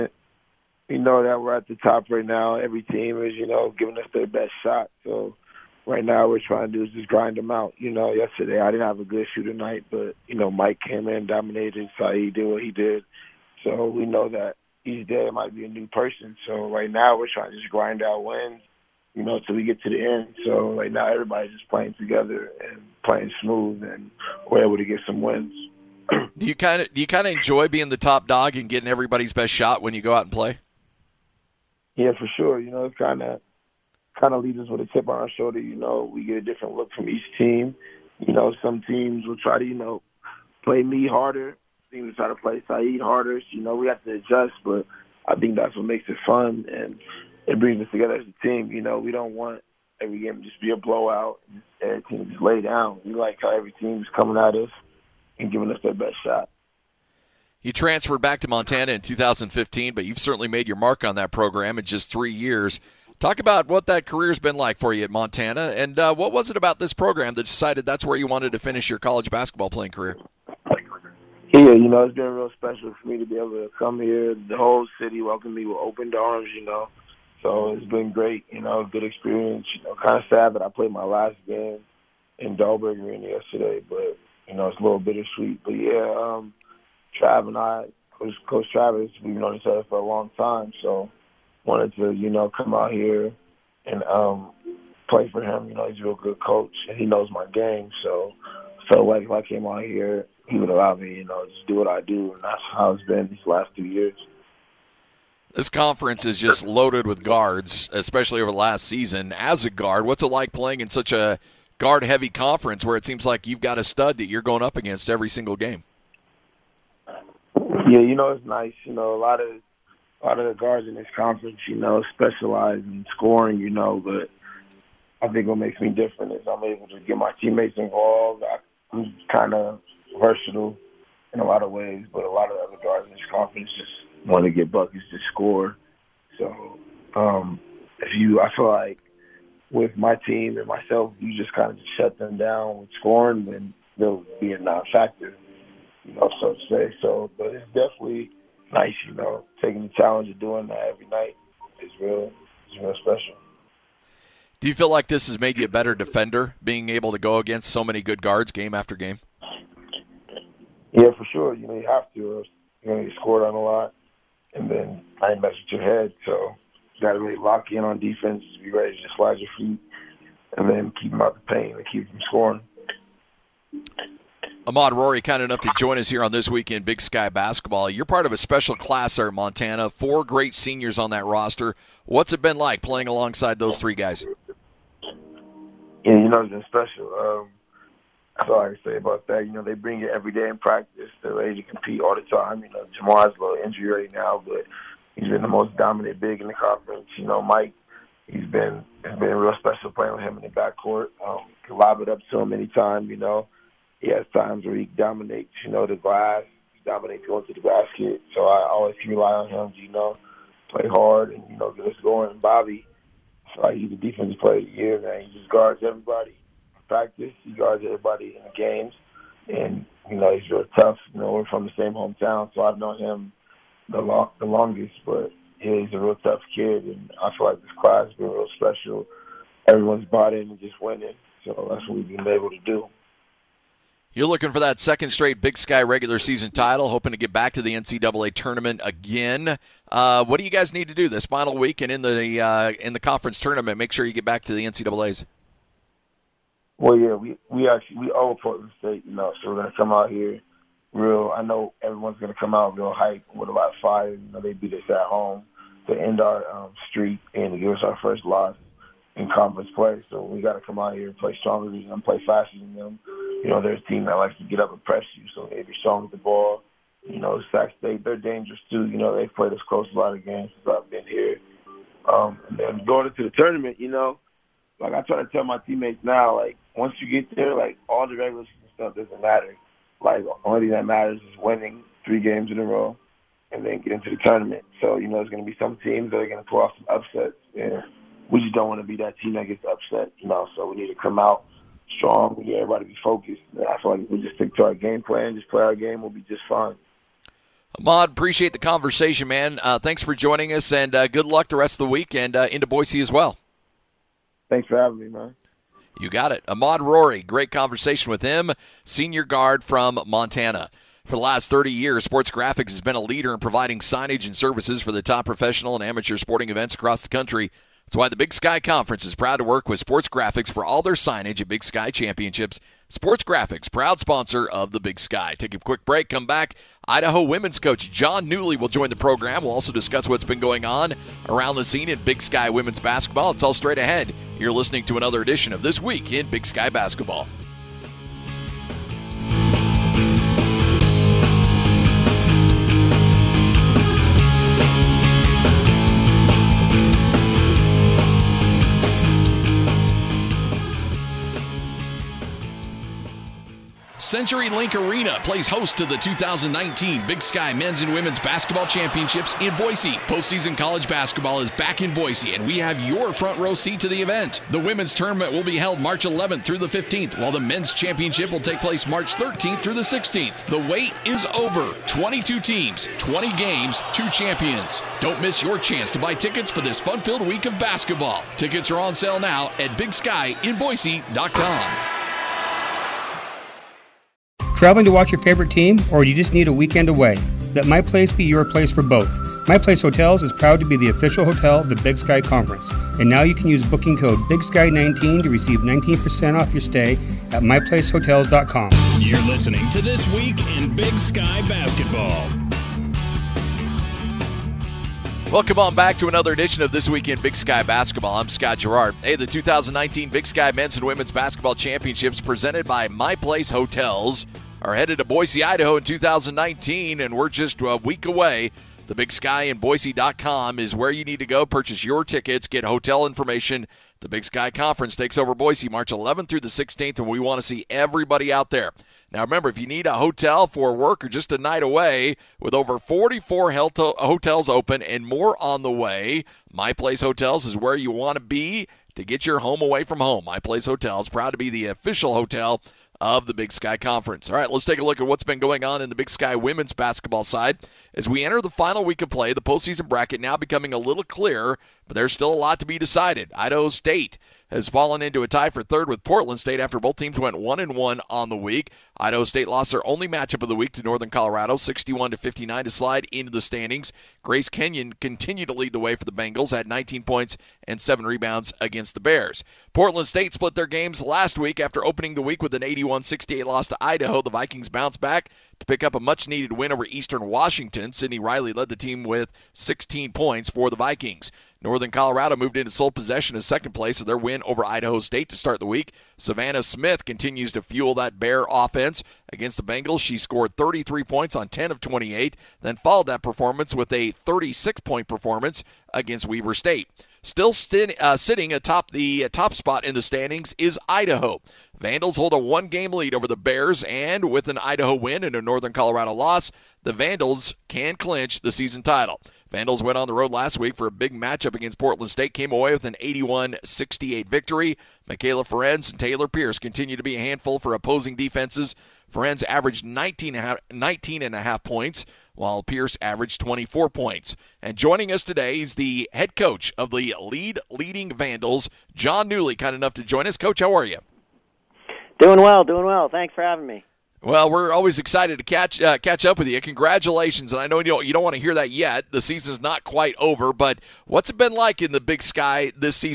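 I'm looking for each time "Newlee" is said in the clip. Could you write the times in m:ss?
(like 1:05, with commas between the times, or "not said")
5:28, 8:49.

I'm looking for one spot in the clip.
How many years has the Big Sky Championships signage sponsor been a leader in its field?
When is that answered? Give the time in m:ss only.
5:11.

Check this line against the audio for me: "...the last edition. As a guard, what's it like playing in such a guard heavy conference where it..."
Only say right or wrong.
wrong.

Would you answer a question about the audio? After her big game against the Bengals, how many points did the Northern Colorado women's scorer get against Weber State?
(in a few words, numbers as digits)
36.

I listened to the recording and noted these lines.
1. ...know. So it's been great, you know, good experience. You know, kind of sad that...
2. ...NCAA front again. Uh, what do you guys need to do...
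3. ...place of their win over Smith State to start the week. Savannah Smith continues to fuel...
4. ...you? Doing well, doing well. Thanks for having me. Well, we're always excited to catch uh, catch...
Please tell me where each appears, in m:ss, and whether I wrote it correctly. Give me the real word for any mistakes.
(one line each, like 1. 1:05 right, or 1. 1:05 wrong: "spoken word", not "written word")
1. 1:16 right
2. 3:57 wrong: "tournament", not "front"
3. 8:03 wrong: "Idaho", not "Smith"
4. 8:50 right.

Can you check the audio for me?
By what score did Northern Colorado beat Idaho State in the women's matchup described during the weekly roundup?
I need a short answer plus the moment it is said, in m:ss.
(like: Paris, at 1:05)
61 to 59, at 7:41.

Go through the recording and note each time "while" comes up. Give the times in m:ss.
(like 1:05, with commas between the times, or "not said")
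6:07, 8:42.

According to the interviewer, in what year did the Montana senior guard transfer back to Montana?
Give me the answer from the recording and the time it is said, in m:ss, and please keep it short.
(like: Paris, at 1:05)
2015, at 0:59.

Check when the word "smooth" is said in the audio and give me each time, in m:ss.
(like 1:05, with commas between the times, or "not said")
0:23.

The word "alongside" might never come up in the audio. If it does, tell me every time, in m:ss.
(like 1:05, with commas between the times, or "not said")
3:03.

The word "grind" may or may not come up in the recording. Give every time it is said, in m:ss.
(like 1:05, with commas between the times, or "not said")
0:07, 0:17.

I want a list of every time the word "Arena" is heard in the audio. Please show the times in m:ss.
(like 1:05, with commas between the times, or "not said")
1:23, 5:54.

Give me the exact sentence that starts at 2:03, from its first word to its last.
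You know, but I think what makes me different is I'm able to get my teammates involved.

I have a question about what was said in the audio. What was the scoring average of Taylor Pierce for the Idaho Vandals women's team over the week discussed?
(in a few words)
24 points.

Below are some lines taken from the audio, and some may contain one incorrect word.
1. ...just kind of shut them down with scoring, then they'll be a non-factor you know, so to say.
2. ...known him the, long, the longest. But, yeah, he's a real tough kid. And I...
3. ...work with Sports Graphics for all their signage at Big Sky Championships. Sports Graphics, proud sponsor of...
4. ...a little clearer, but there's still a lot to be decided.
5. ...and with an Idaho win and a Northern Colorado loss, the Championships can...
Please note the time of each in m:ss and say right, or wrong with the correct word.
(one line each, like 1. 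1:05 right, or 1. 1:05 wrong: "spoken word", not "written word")
1. 2:21 right
2. 3:42 right
3. 5:19 right
4. 7:30 right
5. 8:23 wrong: "Vandals", not "Championships".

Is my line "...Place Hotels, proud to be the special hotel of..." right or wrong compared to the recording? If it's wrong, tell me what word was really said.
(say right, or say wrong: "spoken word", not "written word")
wrong: "official", not "special".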